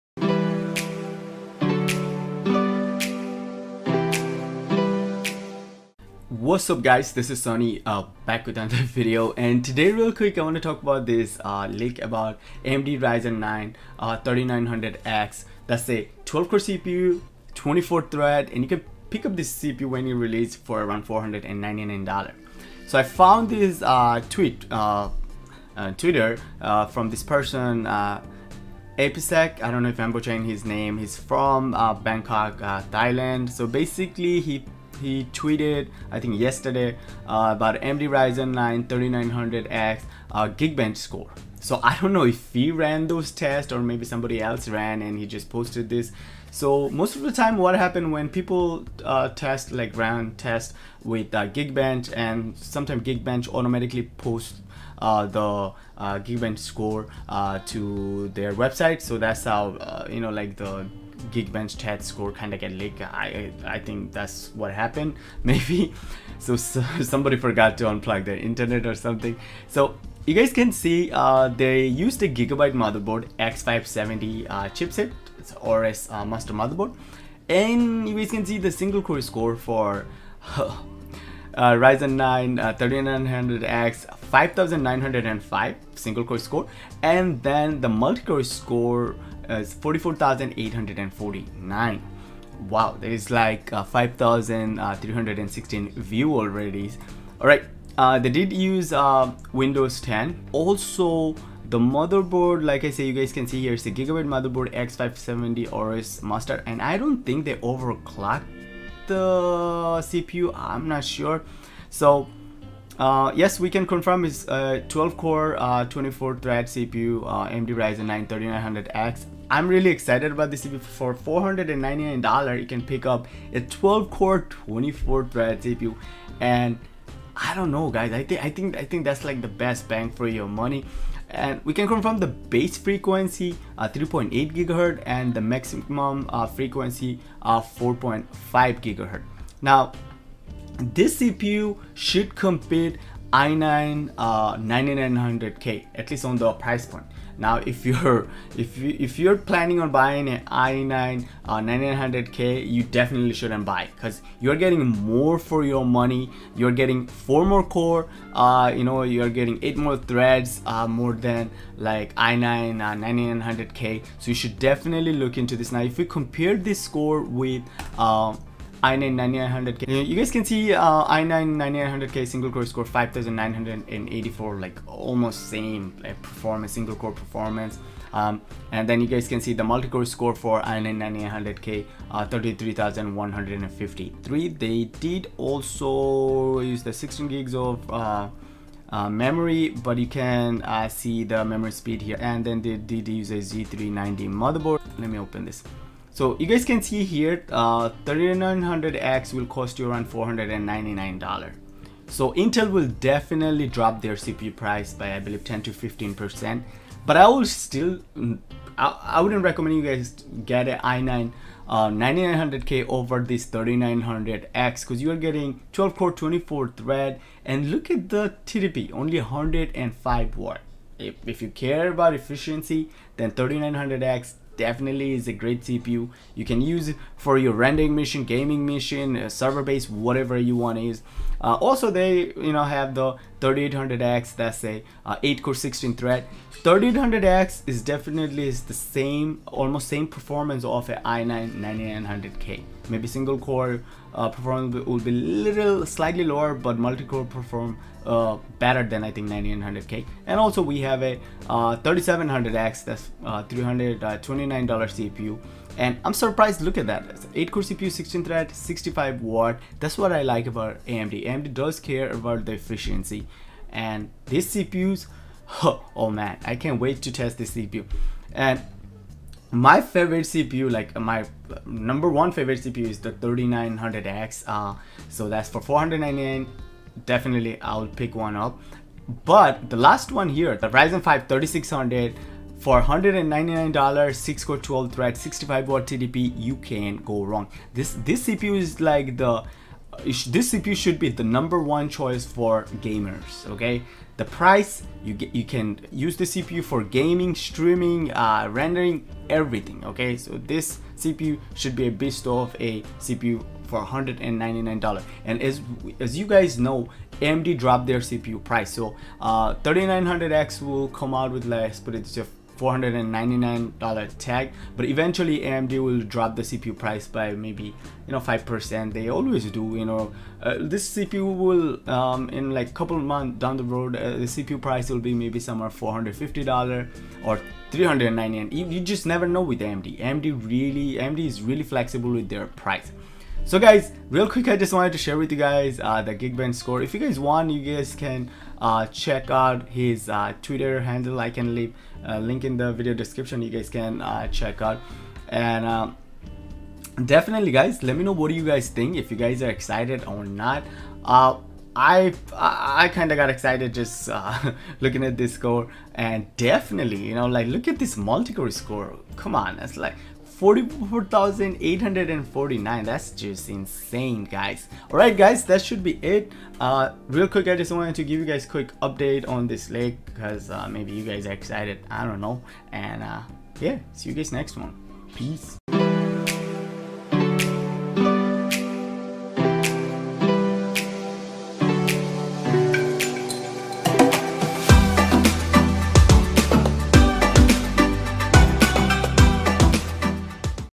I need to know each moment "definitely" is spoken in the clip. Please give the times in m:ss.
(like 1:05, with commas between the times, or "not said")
2:32, 2:44, 3:22, 3:44, 3:57, 4:37, 5:47, 5:56.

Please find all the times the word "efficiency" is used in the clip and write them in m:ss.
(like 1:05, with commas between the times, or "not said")
3:42, 4:22.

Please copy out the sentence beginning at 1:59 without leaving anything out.
I'm really excited about this CPU for $499.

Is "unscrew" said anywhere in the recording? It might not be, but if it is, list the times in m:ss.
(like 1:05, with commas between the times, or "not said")
not said.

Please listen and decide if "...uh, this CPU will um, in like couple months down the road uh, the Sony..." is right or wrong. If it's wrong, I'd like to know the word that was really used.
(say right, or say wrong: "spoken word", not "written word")
wrong: "CPU", not "Sony".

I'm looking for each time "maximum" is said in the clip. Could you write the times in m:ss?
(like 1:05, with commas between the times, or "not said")
2:15.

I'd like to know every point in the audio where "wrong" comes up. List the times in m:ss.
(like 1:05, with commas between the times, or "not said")
4:47.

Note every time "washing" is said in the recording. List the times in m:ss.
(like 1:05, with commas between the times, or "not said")
not said.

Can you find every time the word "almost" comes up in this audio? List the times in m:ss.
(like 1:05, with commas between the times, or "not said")
2:54, 3:59.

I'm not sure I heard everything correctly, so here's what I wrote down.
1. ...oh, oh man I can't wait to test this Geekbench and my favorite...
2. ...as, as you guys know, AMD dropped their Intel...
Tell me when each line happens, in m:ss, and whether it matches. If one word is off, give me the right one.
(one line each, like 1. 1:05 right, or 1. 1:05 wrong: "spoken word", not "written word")
1. 4:25 wrong: "CPU", not "Geekbench"
2. 5:05 wrong: "CPU", not "Intel".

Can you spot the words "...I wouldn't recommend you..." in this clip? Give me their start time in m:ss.
3:29.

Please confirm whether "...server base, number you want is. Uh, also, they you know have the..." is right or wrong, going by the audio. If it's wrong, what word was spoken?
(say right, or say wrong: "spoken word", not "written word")
wrong: "whatever", not "number".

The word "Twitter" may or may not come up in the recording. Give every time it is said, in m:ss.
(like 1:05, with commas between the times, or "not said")
0:25, 5:40.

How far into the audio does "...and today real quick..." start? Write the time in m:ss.
0:09.